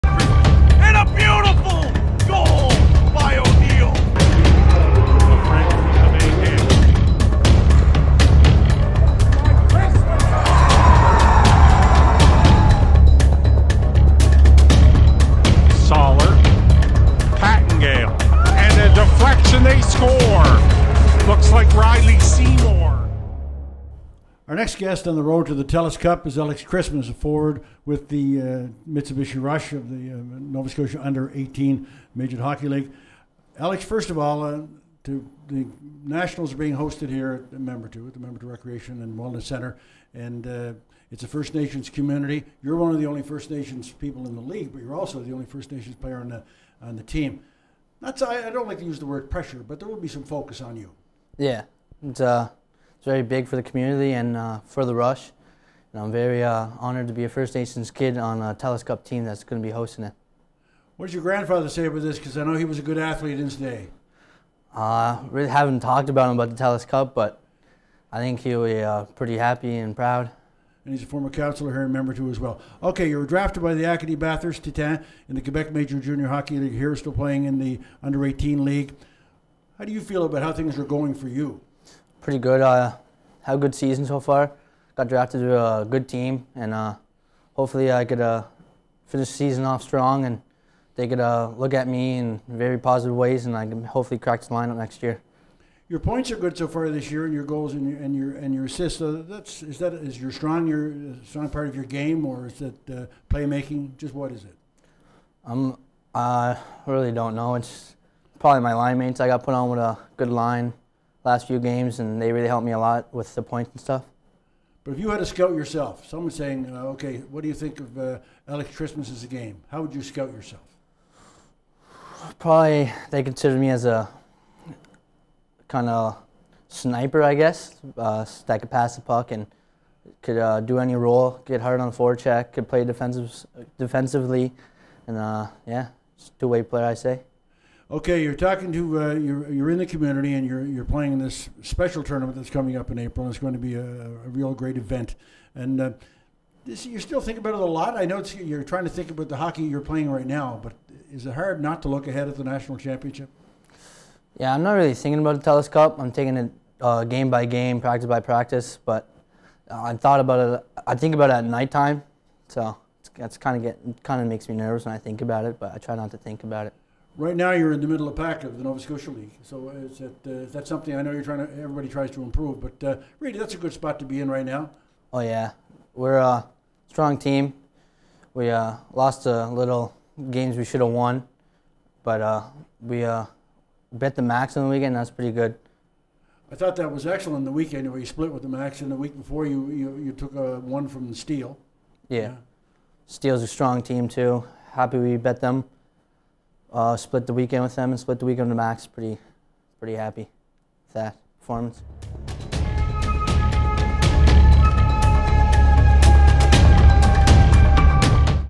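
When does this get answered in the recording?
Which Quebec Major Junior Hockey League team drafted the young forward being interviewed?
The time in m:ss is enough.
1:13.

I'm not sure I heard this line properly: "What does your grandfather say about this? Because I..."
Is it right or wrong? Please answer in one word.
right.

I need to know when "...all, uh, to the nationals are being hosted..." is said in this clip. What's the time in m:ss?
0:34.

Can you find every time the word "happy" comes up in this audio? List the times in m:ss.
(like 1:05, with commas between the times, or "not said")
1:09, 3:14, 3:19.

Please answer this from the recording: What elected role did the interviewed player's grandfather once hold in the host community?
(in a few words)
Councillor.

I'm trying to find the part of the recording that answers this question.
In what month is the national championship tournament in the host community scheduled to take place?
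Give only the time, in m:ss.
2:22.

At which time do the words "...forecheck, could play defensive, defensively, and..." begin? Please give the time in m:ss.
2:11.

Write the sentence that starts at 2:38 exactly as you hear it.
But uh, I thought about it.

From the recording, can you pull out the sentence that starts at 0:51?
Yeah, it's uh, it's very big for the community and uh, for the rush.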